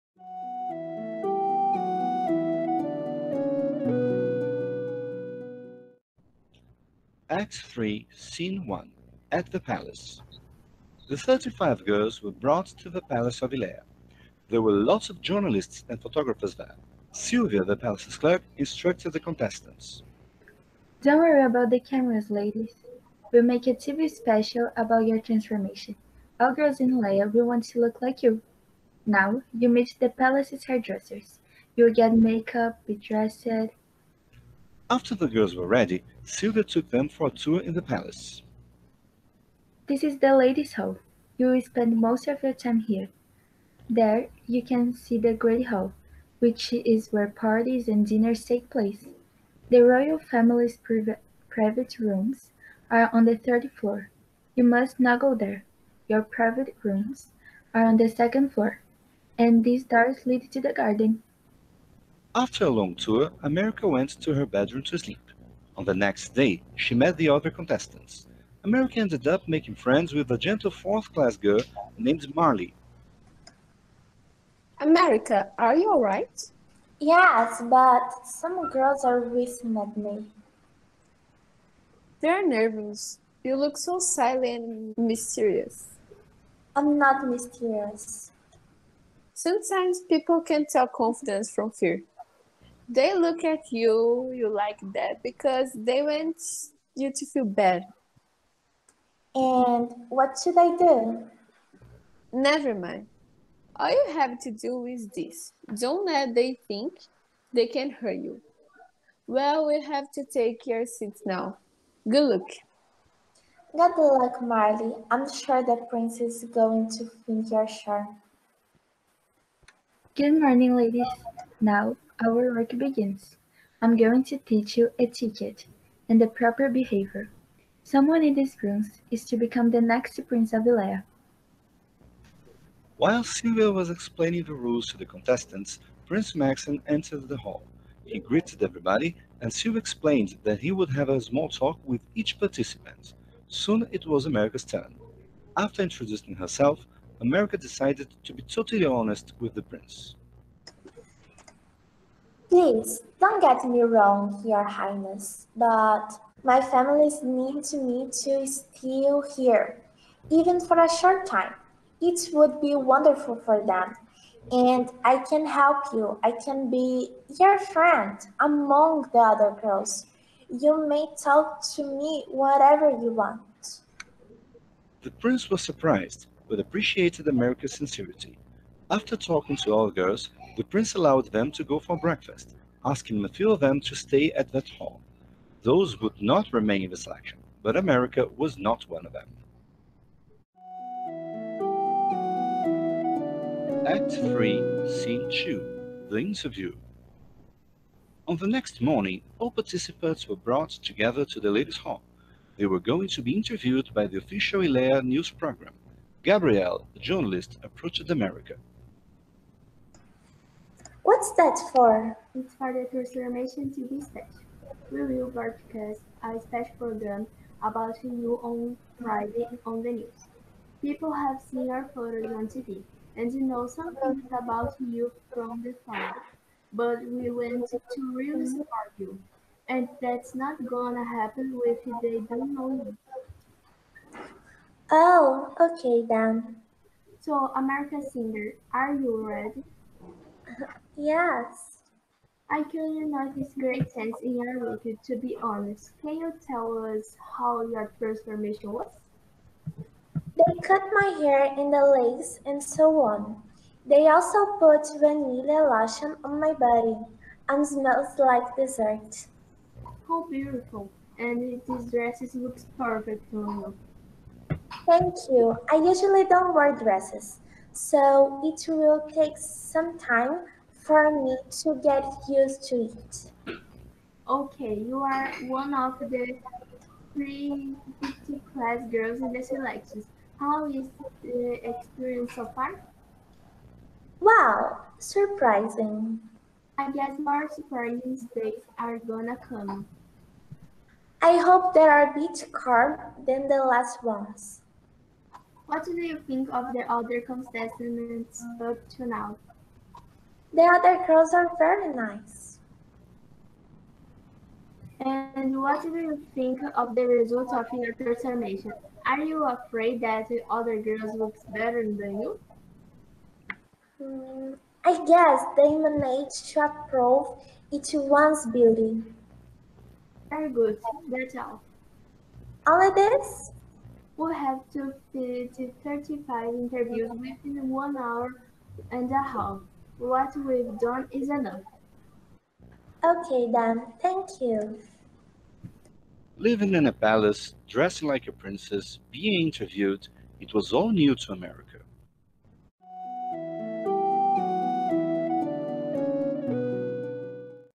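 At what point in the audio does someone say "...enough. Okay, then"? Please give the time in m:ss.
5:31.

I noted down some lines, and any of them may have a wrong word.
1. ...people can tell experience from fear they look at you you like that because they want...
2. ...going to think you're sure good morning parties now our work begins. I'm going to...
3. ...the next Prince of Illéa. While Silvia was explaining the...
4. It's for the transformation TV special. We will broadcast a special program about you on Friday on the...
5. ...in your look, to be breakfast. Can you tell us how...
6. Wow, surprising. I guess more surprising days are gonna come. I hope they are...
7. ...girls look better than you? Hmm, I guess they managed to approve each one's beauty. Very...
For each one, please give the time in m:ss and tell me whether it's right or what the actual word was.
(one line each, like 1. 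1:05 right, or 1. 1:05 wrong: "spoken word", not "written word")
1. 1:30 wrong: "confidence", not "experience"
2. 1:56 wrong: "ladies", not "parties"
3. 2:09 right
4. 3:32 right
5. 4:04 wrong: "honest", not "breakfast"
6. 4:44 right
7. 5:10 right.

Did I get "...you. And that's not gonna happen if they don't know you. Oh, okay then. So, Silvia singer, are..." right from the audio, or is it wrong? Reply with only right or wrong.
wrong.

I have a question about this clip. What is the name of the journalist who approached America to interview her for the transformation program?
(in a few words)
Gabrielle.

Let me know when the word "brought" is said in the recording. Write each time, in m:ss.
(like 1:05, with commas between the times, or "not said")
0:12, 3:20.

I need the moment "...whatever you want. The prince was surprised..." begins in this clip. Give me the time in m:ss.
2:52.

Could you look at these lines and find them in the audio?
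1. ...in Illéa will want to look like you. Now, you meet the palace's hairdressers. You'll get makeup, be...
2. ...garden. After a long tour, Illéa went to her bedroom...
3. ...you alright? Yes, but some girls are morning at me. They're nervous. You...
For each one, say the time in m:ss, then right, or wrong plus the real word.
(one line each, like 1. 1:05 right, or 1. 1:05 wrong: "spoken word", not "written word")
1. 0:26 right
2. 1:00 wrong: "America", not "Illéa"
3. 1:15 wrong: "whistling", not "morning".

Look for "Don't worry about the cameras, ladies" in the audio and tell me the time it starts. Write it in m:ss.
0:21.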